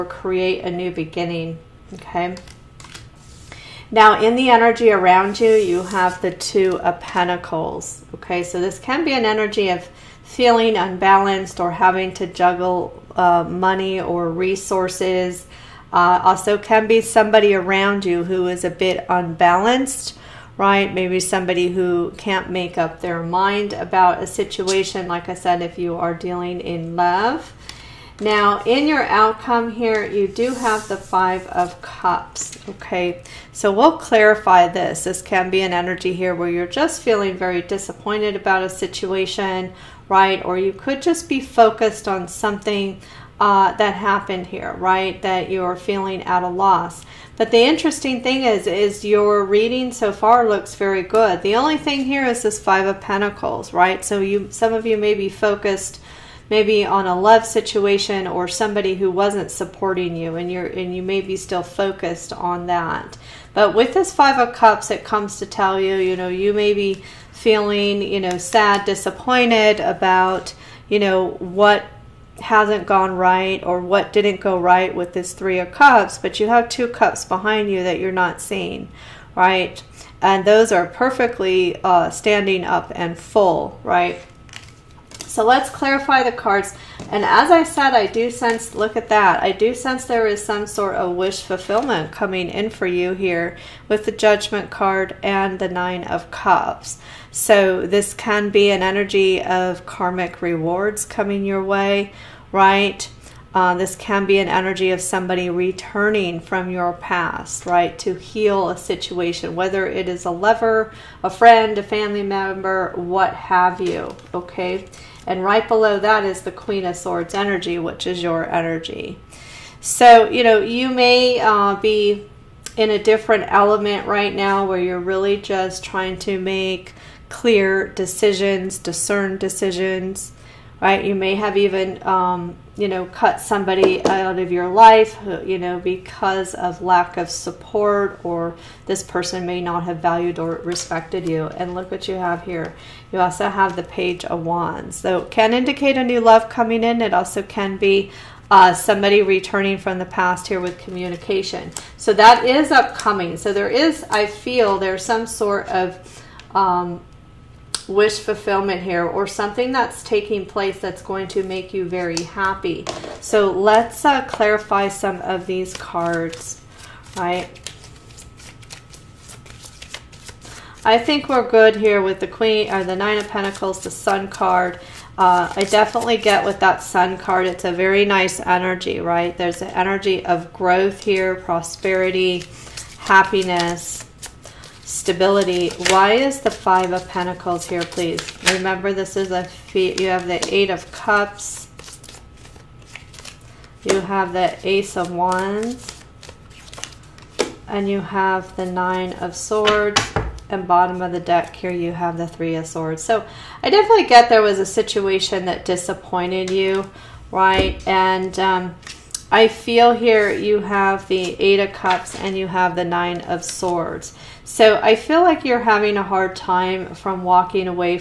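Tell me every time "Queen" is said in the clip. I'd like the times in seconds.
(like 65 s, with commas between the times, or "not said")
116 s, 172 s.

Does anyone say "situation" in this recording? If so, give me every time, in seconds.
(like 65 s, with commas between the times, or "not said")
24 s, 38 s, 57 s, 108 s, 204 s.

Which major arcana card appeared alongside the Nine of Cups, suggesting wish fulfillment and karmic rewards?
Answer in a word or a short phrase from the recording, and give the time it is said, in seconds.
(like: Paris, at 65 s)
Judgment, at 94 s.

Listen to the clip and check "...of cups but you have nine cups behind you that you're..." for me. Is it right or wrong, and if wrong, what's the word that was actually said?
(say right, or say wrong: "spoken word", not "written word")
wrong: "two", not "nine".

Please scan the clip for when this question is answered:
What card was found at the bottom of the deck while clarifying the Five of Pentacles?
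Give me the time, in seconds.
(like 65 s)
202 s.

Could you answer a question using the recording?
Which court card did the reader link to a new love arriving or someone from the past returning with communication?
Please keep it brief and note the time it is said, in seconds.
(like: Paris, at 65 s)
Page of Wands, at 143 s.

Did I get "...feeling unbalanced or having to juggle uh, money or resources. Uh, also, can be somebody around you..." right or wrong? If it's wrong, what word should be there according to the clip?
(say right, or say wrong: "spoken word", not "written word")
right.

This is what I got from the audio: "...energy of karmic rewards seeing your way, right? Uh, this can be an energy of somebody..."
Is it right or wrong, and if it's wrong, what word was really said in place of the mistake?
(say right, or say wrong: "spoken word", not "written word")
wrong: "coming", not "seeing".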